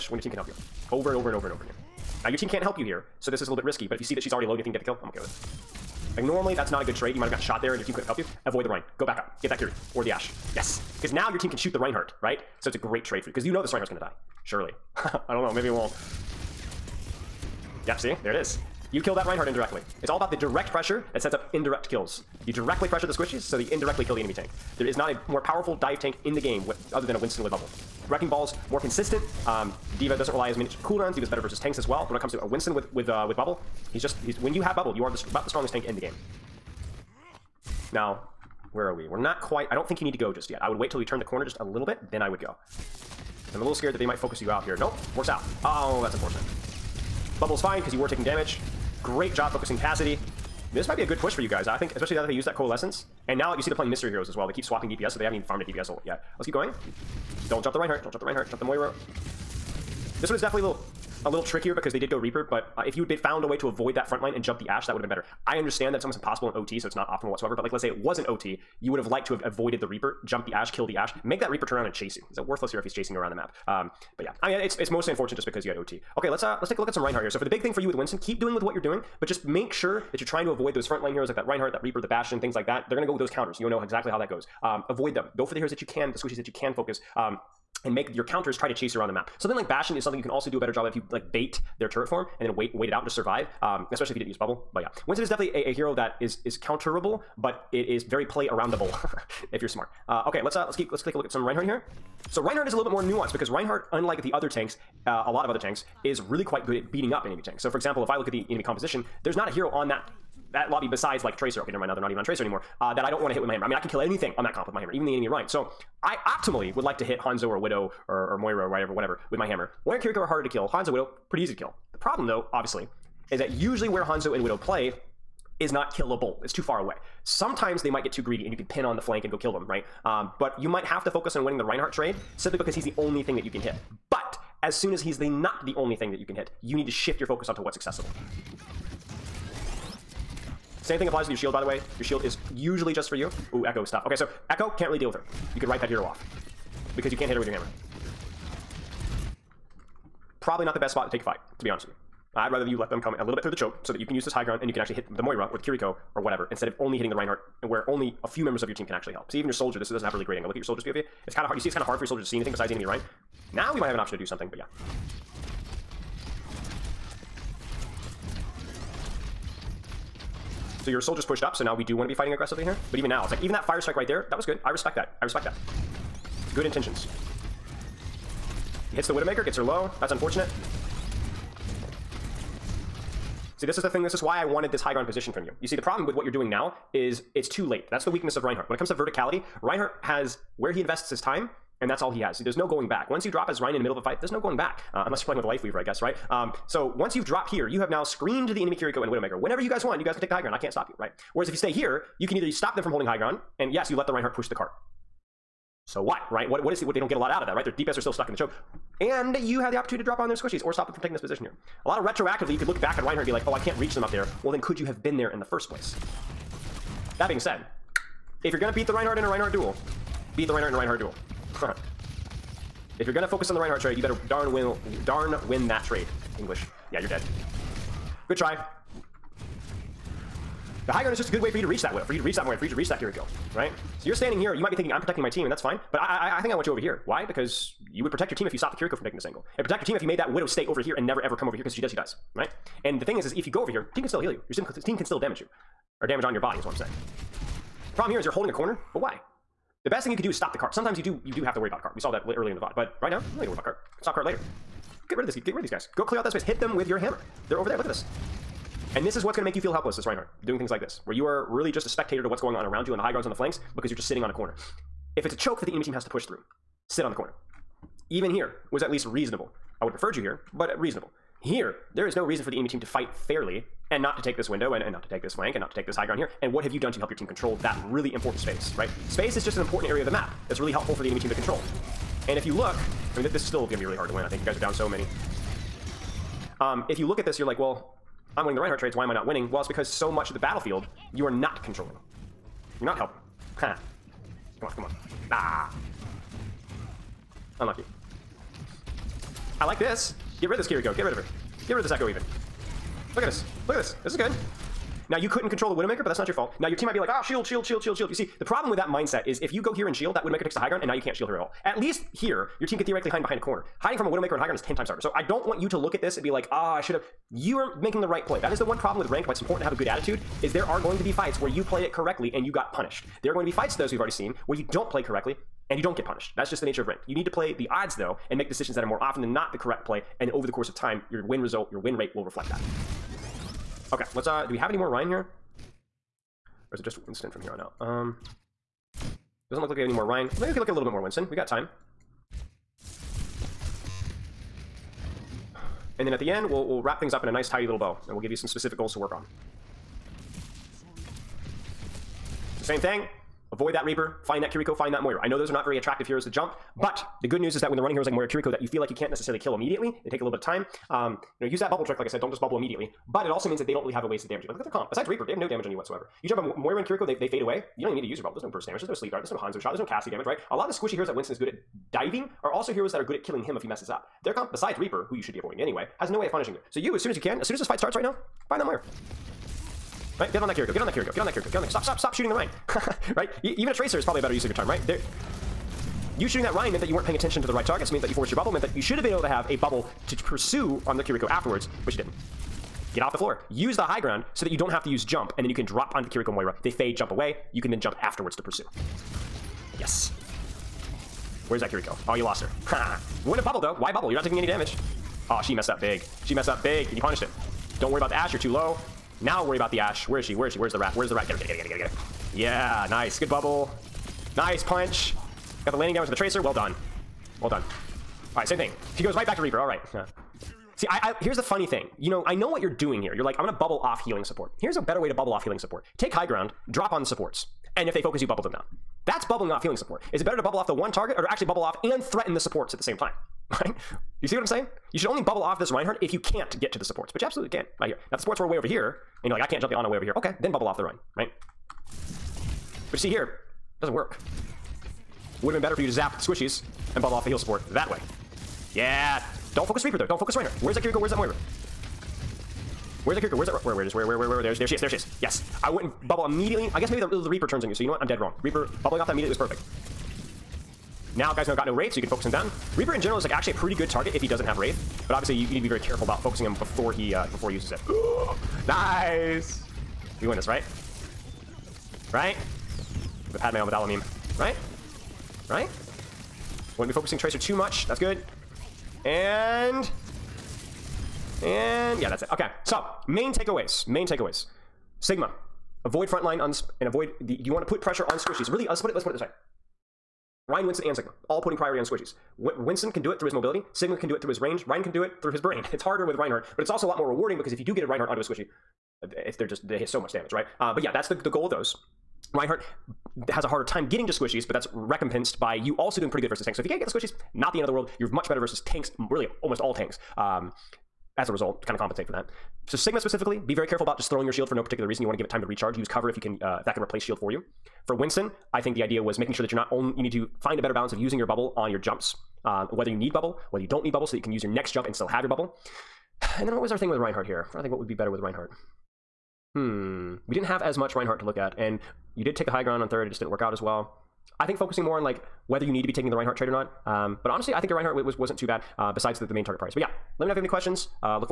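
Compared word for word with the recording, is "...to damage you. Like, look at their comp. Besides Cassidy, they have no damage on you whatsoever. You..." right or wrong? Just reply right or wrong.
wrong.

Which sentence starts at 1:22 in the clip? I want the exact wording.
They're gonna go with those counters.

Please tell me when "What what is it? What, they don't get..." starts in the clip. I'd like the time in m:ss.
3:26.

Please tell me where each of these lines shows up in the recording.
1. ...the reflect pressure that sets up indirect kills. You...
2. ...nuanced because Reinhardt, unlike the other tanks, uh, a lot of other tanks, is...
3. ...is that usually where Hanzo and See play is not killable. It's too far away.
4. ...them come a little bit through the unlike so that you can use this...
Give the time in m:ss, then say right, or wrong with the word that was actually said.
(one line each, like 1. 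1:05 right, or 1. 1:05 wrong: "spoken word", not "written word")
1. 0:20 wrong: "direct", not "reflect"
2. 1:43 right
3. 2:03 wrong: "Widow", not "See"
4. 2:32 wrong: "choke", not "unlike".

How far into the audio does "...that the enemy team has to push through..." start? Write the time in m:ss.
4:25.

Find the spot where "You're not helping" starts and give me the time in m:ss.
4:52.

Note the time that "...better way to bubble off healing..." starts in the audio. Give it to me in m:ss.
7:04.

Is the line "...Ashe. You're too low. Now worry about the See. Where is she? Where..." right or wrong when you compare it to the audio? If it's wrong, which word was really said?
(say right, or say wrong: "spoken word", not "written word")
wrong: "Ashe", not "See".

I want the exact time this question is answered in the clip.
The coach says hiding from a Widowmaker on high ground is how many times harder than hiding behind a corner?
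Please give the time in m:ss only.
5:14.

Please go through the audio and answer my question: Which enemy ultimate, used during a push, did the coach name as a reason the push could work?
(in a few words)
Coalescence.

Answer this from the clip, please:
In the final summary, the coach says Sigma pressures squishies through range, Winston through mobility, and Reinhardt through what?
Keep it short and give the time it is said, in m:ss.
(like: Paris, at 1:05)
his brain, at 8:15.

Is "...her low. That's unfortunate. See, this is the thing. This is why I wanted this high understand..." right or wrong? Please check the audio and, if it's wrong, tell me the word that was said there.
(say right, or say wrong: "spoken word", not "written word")
wrong: "ground", not "understand".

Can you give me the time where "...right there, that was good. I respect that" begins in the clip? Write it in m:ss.
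2:53.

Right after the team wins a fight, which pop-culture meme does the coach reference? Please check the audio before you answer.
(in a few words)
Padme Amidala meme.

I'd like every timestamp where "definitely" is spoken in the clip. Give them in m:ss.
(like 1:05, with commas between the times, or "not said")
1:00, 1:35.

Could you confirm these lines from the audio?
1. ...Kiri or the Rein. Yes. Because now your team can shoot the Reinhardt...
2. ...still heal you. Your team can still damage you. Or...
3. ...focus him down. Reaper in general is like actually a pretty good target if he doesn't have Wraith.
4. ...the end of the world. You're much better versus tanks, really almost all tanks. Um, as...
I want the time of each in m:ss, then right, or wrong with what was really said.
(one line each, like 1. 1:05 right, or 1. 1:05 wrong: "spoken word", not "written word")
1. 0:09 wrong: "Ashe", not "Rein"
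2. 4:04 right
3. 7:42 right
4. 8:27 right.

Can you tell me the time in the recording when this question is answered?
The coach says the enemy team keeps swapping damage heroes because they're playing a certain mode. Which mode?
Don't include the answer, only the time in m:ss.
0:53.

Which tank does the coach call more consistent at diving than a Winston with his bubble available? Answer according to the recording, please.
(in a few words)
Wrecking Ball.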